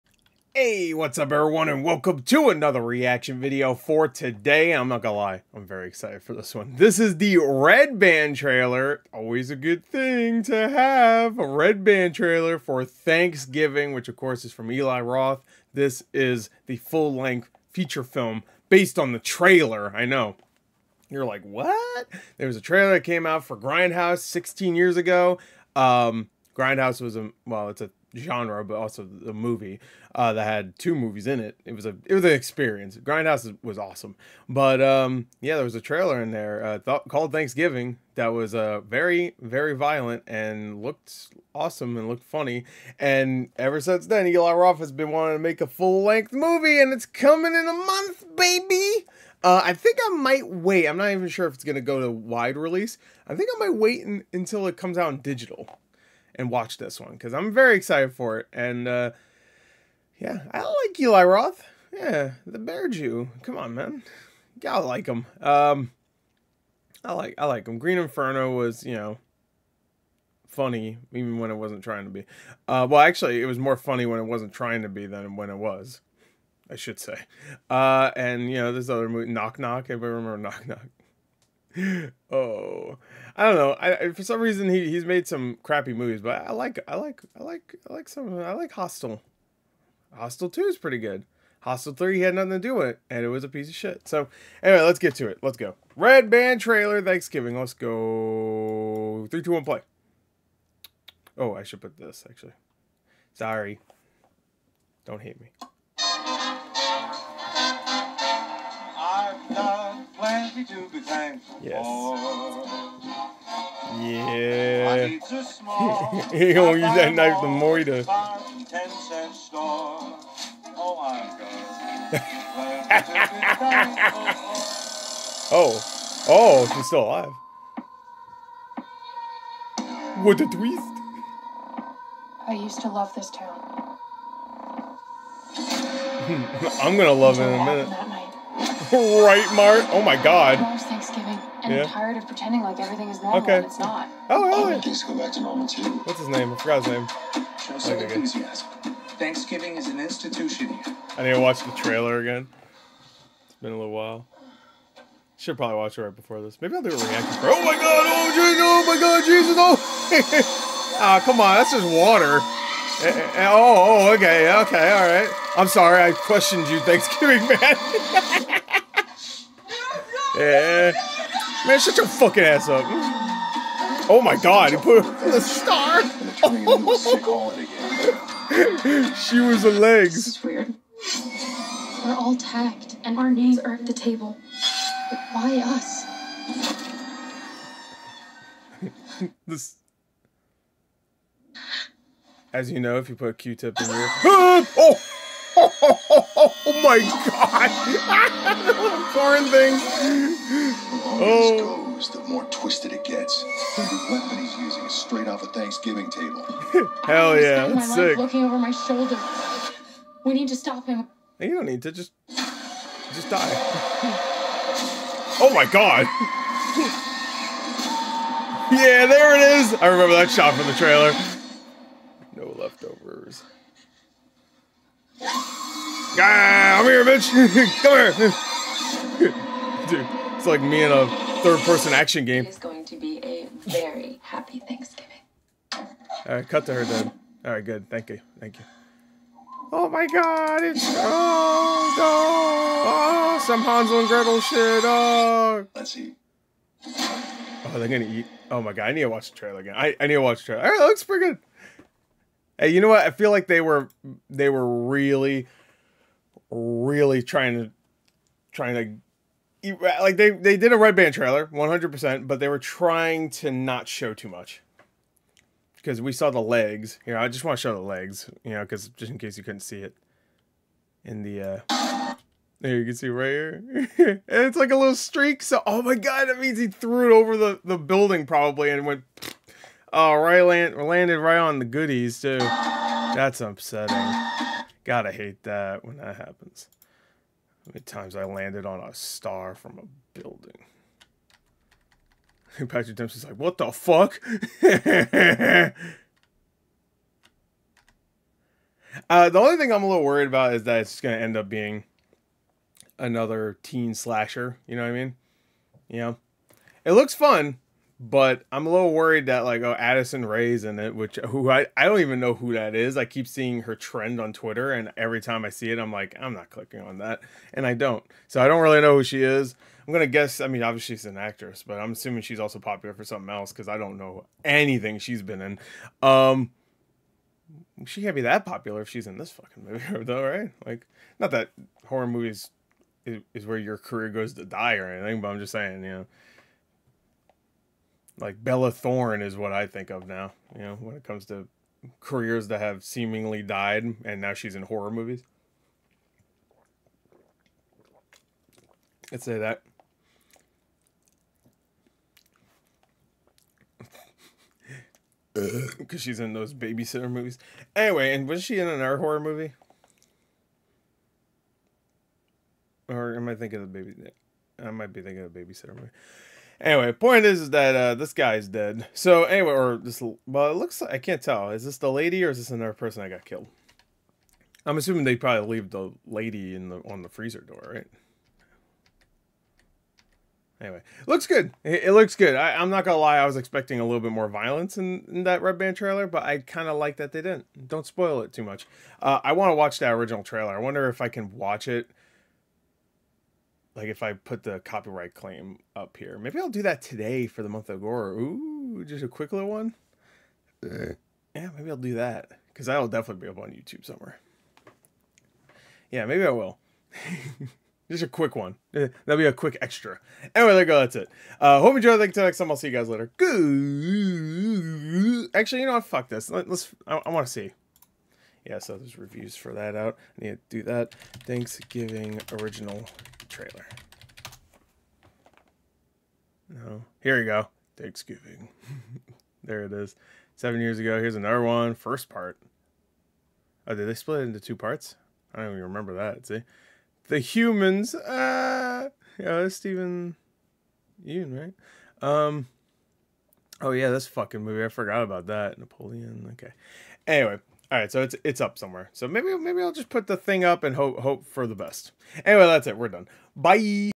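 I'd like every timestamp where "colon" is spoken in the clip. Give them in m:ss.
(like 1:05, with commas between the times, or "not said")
not said.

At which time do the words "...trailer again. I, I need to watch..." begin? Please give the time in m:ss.
4:09.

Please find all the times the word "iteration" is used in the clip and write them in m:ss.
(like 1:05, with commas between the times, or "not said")
not said.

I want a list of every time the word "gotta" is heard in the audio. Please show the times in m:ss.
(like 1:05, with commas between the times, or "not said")
1:04, 4:44.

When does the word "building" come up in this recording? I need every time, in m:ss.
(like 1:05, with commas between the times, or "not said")
4:37, 4:50.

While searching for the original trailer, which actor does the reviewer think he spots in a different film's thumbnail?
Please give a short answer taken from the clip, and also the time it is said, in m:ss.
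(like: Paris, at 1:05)
Steven Yeun, at 7:19.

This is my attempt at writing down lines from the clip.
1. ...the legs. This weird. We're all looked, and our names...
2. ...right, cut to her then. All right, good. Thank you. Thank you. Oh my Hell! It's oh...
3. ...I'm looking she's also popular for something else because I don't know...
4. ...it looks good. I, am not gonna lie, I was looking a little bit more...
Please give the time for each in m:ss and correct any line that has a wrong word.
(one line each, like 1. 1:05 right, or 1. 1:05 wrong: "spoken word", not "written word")
1. 2:59 wrong: "tagged", not "looked"
2. 3:56 wrong: "God", not "Hell"
3. 5:21 wrong: "assuming", not "looking"
4. 6:21 wrong: "expecting", not "looking".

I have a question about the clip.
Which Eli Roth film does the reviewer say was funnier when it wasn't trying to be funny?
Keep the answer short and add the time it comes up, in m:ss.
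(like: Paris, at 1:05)
Green Inferno, at 1:07.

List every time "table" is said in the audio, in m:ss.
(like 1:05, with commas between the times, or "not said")
3:03, 3:26.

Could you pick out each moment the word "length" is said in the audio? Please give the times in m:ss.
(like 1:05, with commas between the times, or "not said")
0:16, 0:46.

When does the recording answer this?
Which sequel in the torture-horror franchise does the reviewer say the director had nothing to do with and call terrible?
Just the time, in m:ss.
1:31.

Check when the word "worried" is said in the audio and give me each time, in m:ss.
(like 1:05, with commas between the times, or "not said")
5:00, 5:08.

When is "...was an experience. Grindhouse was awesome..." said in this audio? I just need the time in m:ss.
0:32.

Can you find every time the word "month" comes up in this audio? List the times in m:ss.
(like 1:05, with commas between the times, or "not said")
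0:47, 6:37.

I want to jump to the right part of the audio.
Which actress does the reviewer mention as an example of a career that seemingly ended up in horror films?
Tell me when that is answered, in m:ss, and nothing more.
5:38.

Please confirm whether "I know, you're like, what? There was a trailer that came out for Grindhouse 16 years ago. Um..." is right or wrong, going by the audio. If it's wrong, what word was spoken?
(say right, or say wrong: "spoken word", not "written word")
right.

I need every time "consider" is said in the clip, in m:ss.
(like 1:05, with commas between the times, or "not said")
not said.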